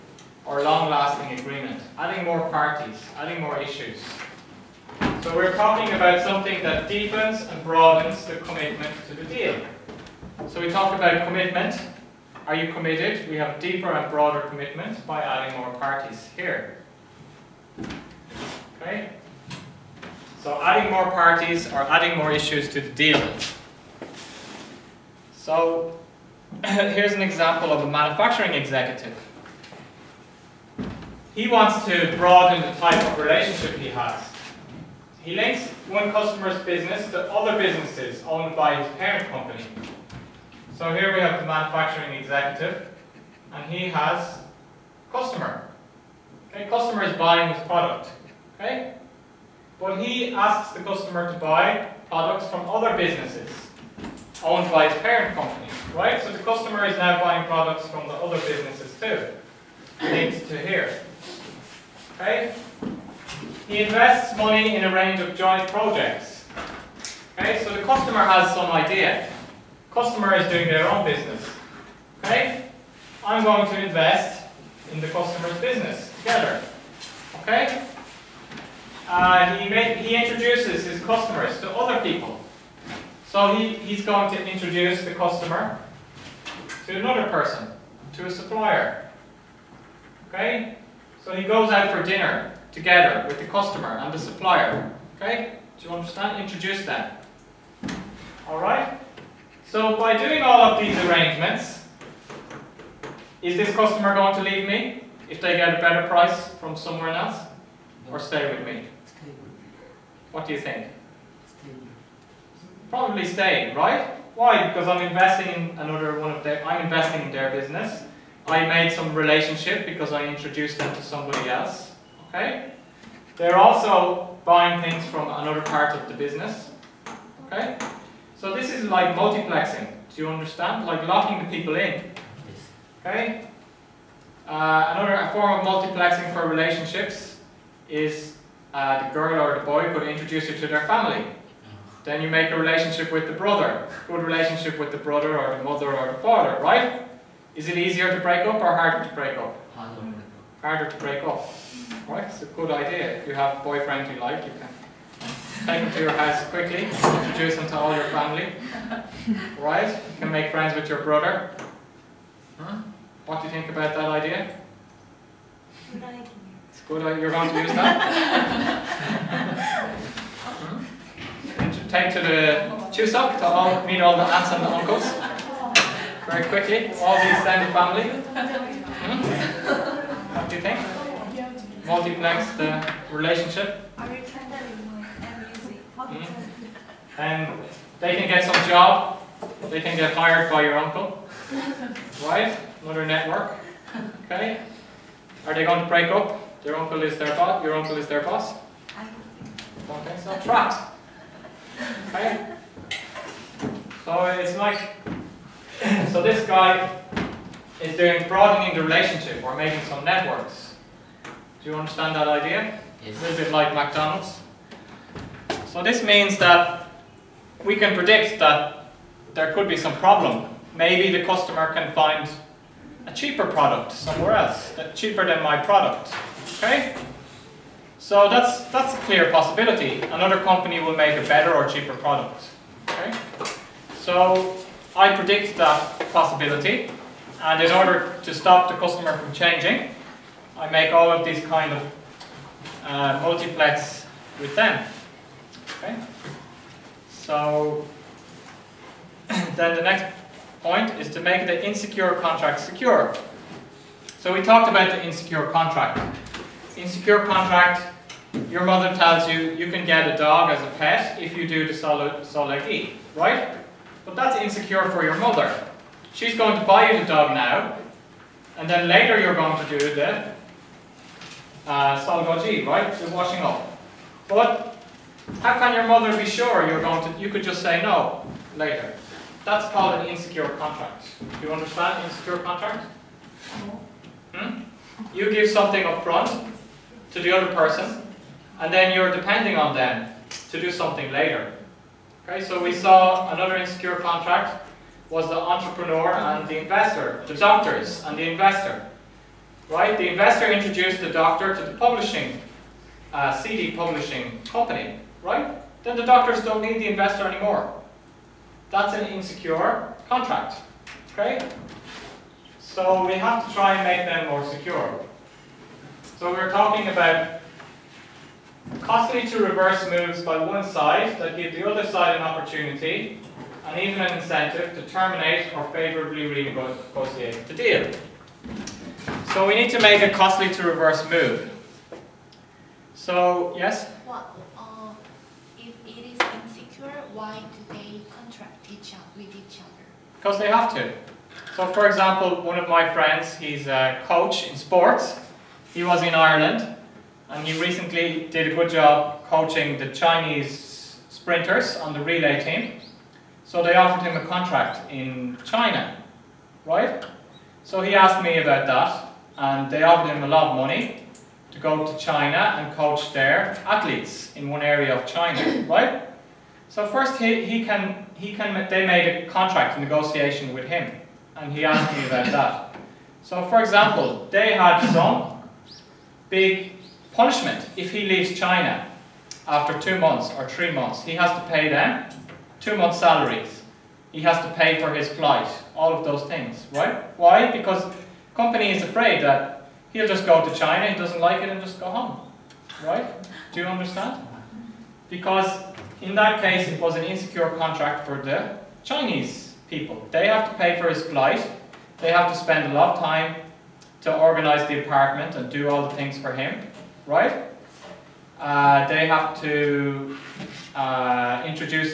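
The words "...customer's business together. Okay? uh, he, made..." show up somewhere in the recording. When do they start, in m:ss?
1:15.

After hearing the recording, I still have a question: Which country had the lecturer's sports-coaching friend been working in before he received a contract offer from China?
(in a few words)
Ireland.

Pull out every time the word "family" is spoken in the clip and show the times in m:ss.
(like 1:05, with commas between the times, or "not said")
2:20, 2:38, 2:57.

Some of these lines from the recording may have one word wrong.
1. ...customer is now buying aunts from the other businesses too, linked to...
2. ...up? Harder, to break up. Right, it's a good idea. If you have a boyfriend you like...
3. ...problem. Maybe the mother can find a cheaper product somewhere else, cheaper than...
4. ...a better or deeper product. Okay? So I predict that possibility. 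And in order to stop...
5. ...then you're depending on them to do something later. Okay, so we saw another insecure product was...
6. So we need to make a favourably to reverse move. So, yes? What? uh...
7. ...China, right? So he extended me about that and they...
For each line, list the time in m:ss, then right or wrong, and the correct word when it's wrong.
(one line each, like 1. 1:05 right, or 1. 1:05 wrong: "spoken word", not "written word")
1. 0:56 wrong: "products", not "aunts"
2. 2:29 right
3. 3:39 wrong: "customer", not "mother"
4. 3:51 wrong: "cheaper", not "deeper"
5. 4:48 wrong: "contract", not "product"
6. 5:29 wrong: "costly", not "favourably"
7. 5:55 wrong: "asked", not "extended".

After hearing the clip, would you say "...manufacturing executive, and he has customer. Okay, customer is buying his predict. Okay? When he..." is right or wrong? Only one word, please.
wrong.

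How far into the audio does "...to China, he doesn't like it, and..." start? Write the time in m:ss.
6:30.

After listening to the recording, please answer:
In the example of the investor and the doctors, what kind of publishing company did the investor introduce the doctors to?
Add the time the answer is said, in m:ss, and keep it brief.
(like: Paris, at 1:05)
CD publishing company, at 5:03.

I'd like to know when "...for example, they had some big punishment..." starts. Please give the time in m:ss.
6:13.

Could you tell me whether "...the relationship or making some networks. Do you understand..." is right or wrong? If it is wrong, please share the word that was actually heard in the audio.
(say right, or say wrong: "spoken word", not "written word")
right.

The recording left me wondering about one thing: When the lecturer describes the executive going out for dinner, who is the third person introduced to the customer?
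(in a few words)
A supplier.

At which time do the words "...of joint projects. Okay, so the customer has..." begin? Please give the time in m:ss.
1:05.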